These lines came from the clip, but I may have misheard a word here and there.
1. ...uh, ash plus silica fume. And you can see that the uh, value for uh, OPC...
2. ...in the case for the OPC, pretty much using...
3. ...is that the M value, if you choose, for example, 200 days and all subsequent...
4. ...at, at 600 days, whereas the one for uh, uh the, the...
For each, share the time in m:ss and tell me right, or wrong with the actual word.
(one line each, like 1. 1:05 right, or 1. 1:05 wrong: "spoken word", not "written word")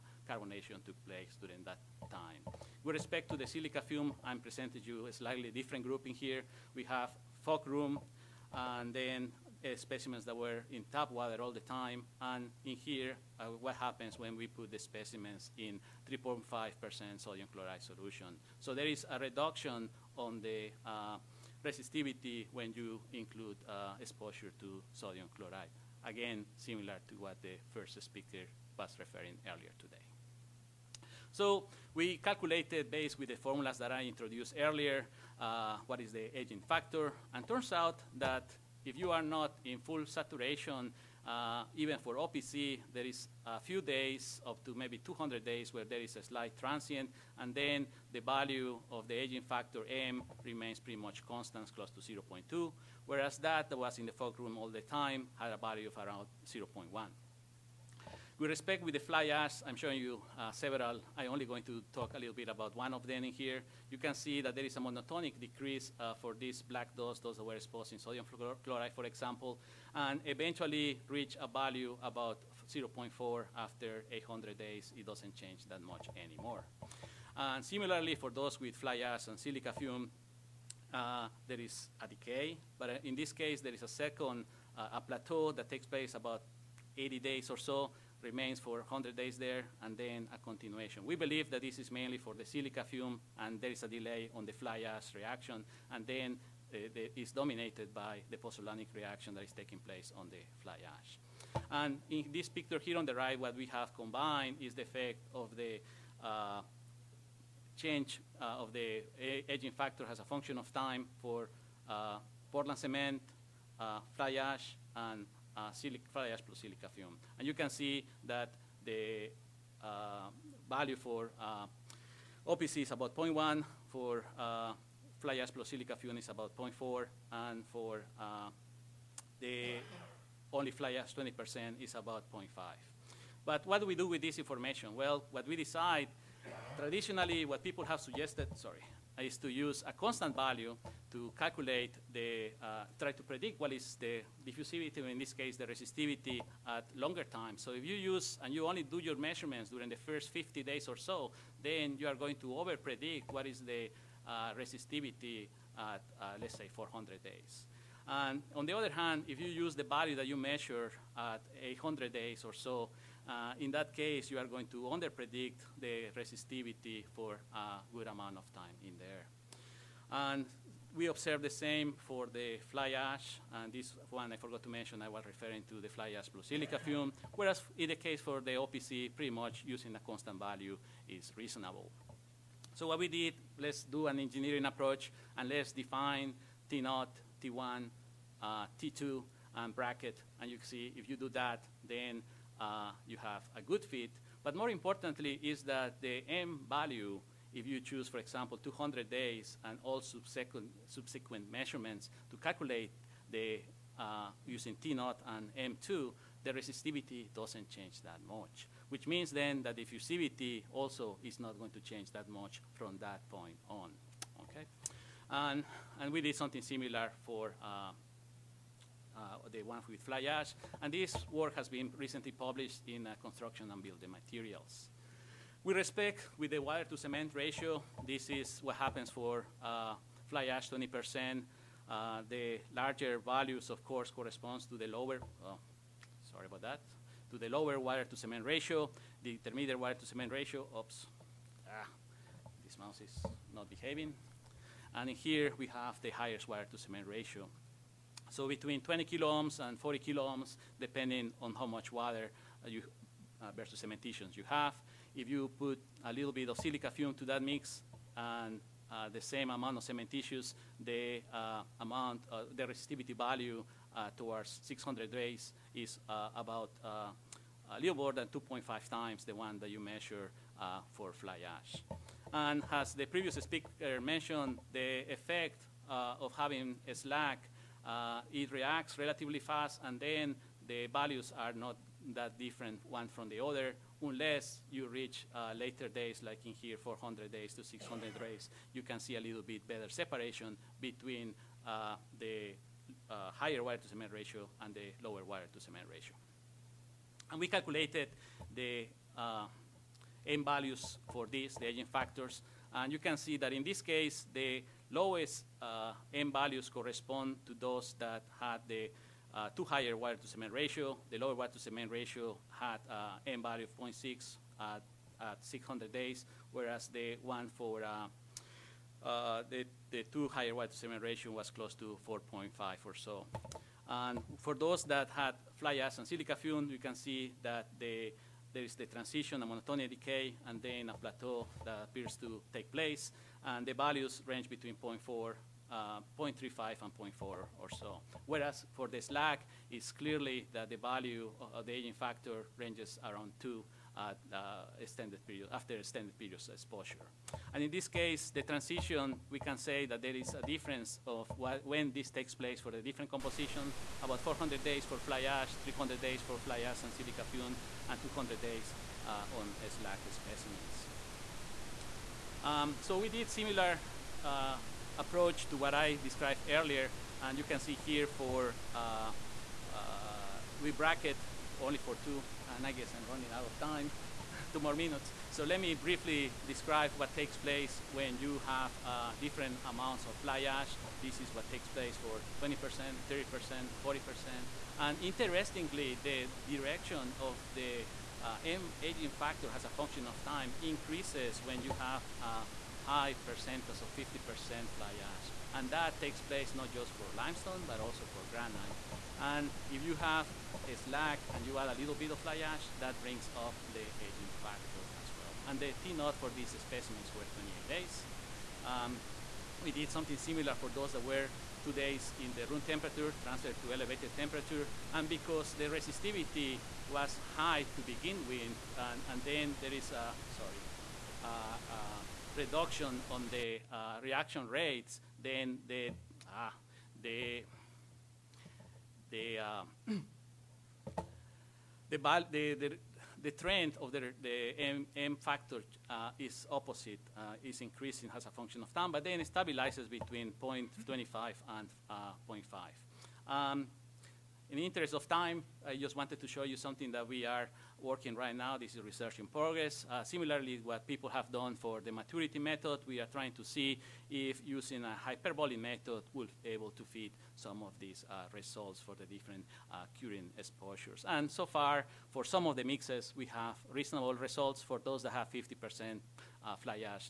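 1. 1:55 right
2. 2:57 right
3. 3:15 right
4. 5:14 right.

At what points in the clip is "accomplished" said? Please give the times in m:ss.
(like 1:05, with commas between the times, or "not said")
not said.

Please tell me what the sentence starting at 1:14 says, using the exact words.
It doesn't change that much anymore.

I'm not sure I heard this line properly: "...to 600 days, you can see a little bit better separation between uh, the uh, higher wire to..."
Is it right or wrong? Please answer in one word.
right.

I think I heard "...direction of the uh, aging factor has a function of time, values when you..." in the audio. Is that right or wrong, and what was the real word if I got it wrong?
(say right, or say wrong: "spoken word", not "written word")
wrong: "increases", not "values".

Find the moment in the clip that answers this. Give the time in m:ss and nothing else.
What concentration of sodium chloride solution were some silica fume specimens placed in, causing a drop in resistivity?
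0:16.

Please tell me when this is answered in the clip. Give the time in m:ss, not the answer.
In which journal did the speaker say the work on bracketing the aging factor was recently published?
3:43.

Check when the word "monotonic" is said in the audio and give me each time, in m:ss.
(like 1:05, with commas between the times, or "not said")
1:04, 5:29.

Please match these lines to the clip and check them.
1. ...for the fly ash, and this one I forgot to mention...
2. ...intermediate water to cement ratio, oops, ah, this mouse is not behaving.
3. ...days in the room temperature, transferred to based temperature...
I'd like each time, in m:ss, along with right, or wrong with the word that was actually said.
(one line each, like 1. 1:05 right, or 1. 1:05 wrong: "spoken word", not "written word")
1. 2:51 right
2. 3:59 right
3. 6:51 wrong: "elevated", not "based".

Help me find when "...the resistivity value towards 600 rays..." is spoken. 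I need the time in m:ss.
4:22.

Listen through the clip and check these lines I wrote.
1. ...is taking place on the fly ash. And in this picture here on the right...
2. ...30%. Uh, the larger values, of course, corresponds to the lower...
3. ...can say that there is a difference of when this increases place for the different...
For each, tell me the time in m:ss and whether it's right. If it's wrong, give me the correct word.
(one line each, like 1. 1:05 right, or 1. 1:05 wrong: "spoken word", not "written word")
1. 1:39 right
2. 3:50 wrong: "20", not "30"
3. 5:49 wrong: "takes", not "increases".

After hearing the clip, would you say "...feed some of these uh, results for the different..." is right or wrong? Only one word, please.
right.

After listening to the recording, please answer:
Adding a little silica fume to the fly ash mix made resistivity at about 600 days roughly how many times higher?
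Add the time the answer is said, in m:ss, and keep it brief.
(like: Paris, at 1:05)
2.5 times, at 4:28.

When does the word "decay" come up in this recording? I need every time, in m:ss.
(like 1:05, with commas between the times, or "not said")
1:22, 5:29.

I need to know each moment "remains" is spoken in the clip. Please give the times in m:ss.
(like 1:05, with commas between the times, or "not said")
0:50, 1:28.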